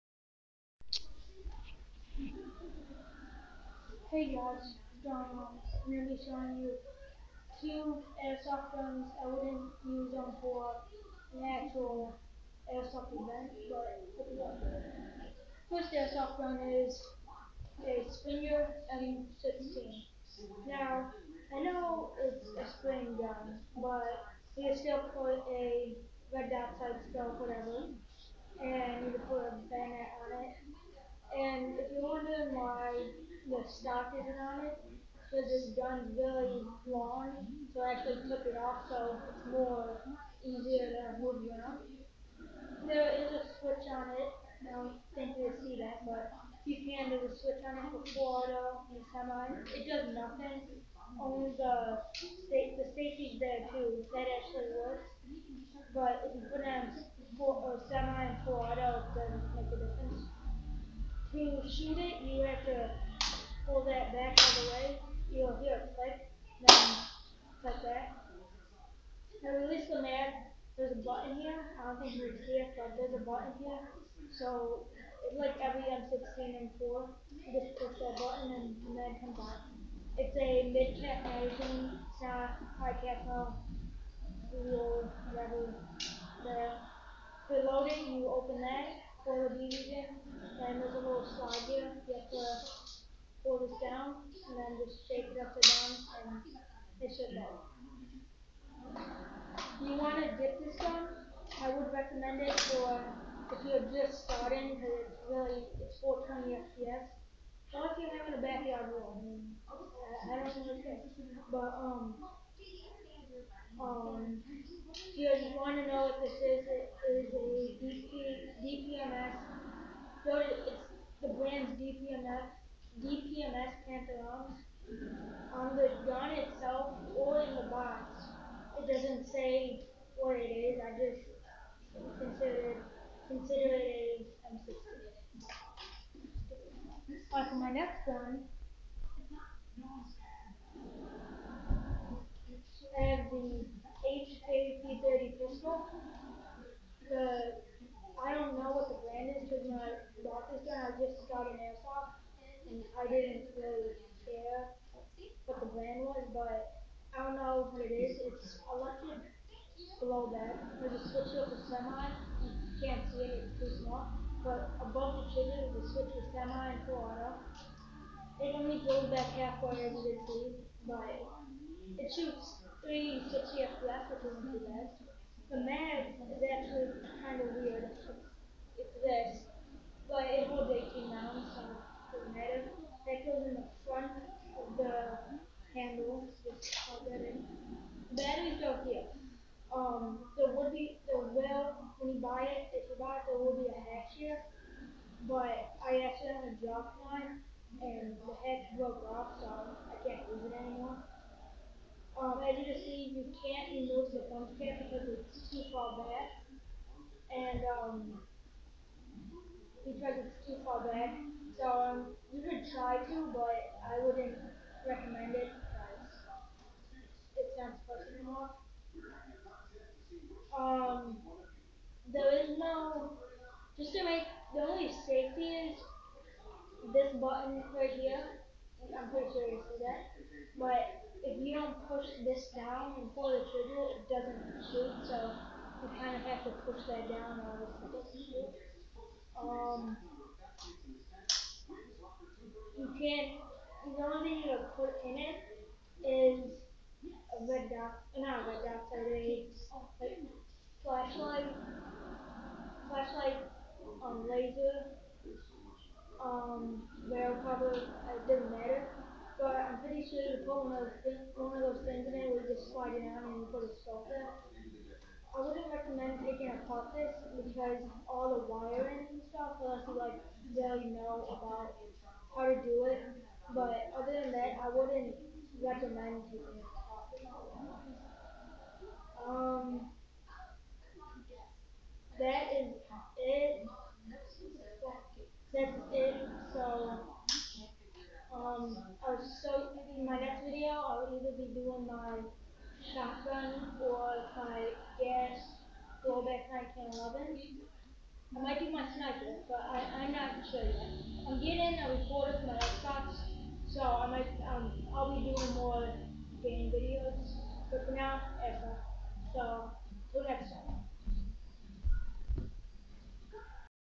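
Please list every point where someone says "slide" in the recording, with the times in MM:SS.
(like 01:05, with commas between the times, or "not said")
01:31, 04:22.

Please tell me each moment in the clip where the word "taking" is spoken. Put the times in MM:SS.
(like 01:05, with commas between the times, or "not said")
04:26, 04:36.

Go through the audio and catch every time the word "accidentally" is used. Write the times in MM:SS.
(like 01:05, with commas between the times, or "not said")
03:16.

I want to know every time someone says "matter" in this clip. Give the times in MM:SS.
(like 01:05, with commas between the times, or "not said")
03:02, 04:18.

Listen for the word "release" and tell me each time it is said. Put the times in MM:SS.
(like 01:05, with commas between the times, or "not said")
01:09.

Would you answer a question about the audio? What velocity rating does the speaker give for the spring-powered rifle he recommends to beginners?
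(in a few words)
420 FPS.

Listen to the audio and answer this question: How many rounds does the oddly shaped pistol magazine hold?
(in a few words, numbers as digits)
18.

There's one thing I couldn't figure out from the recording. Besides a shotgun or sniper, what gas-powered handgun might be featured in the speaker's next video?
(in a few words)
gas blowback 1911.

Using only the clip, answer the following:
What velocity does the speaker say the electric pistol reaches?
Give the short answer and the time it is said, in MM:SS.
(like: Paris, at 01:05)
360 FPS, at 02:52.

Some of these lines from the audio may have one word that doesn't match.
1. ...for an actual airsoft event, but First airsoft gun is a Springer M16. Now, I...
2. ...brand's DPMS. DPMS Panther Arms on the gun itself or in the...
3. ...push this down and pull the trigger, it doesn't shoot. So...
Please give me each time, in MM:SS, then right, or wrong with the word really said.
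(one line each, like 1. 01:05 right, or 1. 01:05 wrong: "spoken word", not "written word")
1. 00:10 right
2. 02:01 right
3. 03:51 right.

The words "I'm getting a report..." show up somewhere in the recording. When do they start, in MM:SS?
05:01.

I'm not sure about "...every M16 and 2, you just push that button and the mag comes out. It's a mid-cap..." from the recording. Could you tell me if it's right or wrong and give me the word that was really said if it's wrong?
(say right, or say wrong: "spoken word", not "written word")
wrong: "4", not "2".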